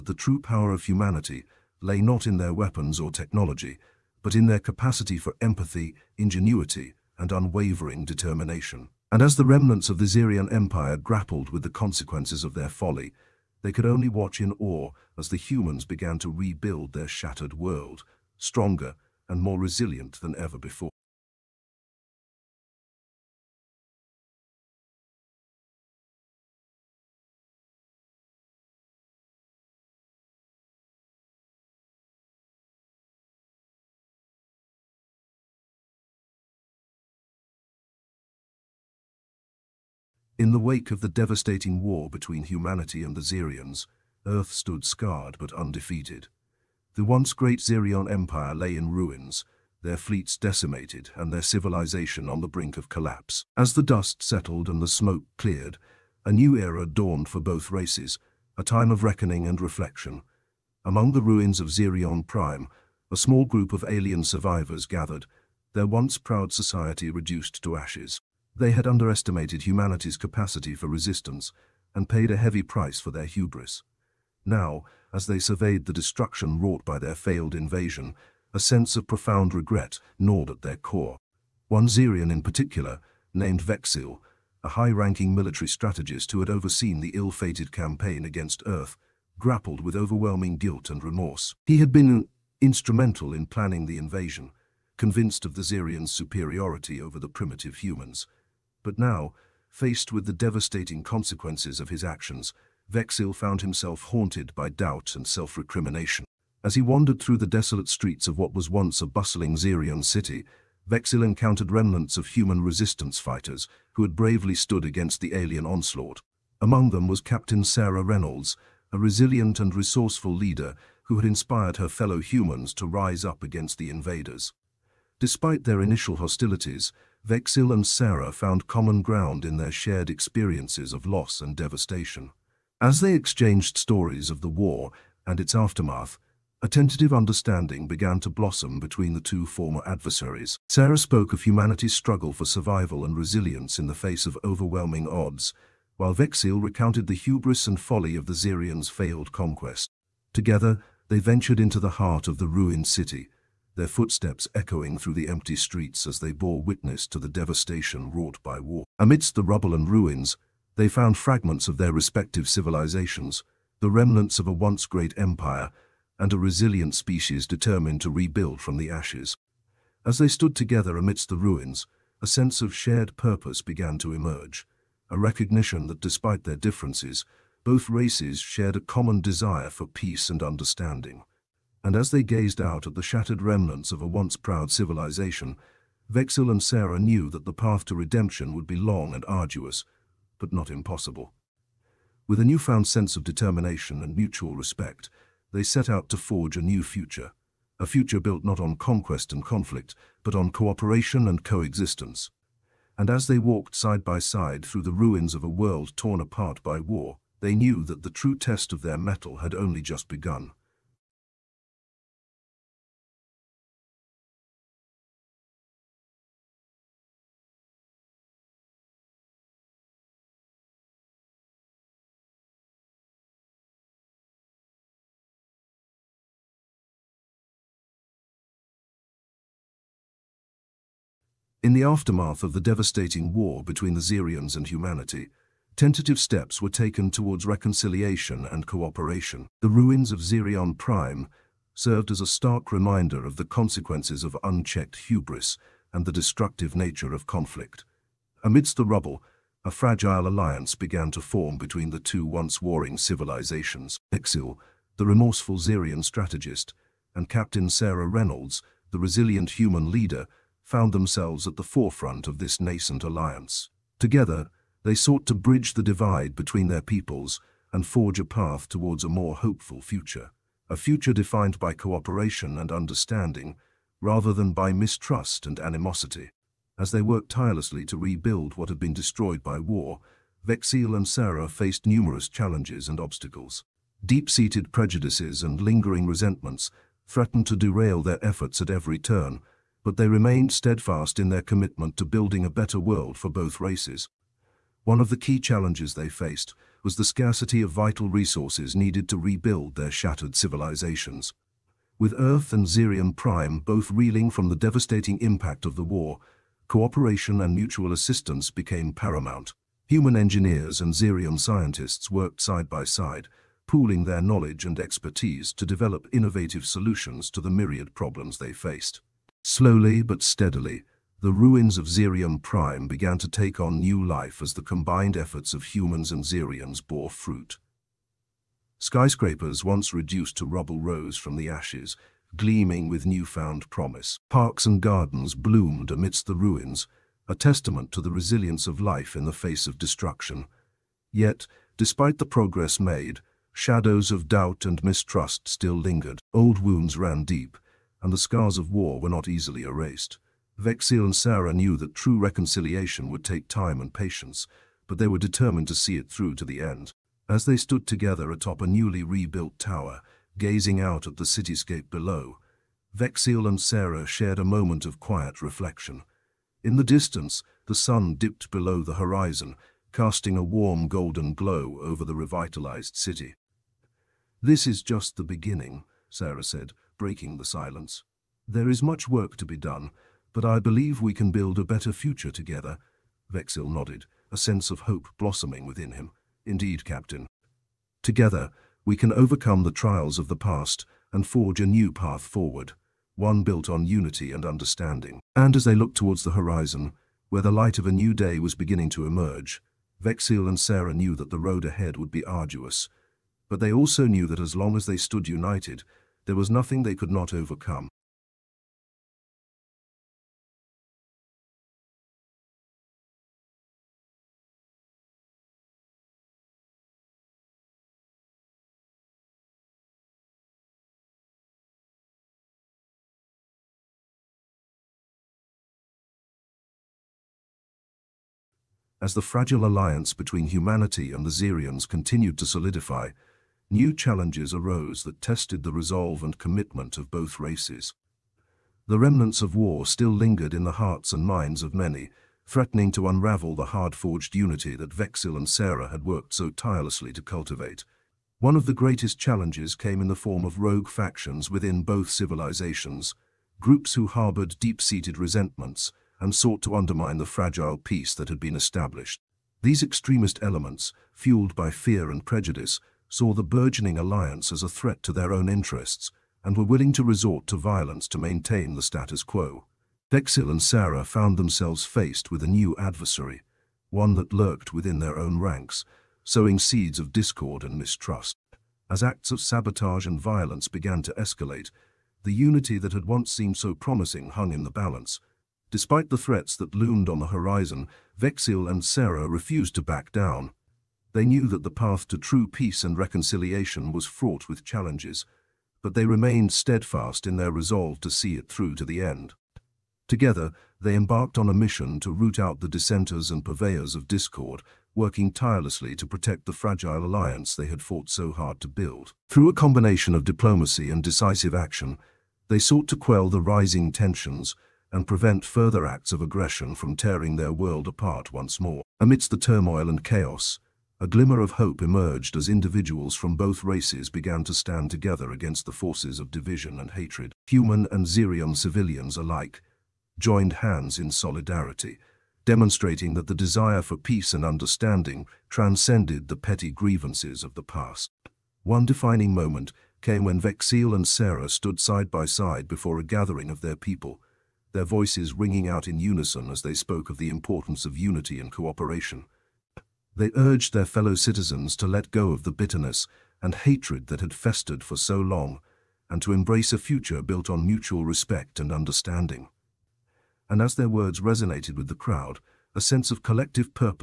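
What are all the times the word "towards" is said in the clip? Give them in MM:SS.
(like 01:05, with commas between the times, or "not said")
03:57, 04:28, 06:35.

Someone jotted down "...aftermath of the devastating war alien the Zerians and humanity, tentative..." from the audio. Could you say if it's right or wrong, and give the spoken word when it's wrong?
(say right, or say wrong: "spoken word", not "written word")
wrong: "between", not "alien".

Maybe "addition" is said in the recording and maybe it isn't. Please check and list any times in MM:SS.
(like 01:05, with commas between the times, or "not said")
not said.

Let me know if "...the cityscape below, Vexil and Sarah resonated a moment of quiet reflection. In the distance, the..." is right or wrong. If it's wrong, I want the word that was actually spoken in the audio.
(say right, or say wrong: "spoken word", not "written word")
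wrong: "shared", not "resonated".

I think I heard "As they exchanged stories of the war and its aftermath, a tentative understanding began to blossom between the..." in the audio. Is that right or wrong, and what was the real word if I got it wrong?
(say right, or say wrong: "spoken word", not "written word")
right.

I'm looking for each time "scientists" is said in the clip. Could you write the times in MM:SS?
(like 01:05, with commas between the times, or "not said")
05:11.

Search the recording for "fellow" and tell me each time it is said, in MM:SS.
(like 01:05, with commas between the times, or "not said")
02:01, 09:10.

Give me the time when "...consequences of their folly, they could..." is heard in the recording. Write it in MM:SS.
00:11.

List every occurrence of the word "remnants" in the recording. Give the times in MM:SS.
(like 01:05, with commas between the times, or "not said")
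00:09, 01:51, 02:43, 03:03, 07:18.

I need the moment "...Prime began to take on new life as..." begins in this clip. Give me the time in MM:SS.
05:22.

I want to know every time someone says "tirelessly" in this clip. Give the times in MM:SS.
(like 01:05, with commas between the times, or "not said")
04:37, 07:26, 08:25.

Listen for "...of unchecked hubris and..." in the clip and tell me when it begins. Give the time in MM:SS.
04:04.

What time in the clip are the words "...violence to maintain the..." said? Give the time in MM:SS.
07:47.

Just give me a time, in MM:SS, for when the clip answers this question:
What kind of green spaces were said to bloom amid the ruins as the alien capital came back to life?
05:34.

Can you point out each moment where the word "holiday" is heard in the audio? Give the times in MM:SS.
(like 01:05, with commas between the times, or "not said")
not said.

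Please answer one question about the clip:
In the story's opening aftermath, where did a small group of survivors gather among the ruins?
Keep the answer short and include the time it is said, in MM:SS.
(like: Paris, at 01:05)
Zirion Prime, at 01:01.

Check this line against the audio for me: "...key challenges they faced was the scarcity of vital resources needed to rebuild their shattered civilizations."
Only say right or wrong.
right.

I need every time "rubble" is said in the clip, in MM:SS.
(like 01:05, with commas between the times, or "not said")
02:39, 04:08, 05:30.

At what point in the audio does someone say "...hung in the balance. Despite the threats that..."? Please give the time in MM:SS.
08:04.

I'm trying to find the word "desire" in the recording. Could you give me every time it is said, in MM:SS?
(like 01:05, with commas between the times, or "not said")
02:59, 08:53.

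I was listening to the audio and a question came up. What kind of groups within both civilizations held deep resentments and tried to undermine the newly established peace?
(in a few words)
rogue factions.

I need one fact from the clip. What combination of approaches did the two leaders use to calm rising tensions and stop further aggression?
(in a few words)
diplomacy and decisive action.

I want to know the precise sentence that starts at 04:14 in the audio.
Vexil, the remorseful Zerian strategist, and Captain Sarah Reynolds, the resilient human leader, found themselves at the forefront of this nascent alliance.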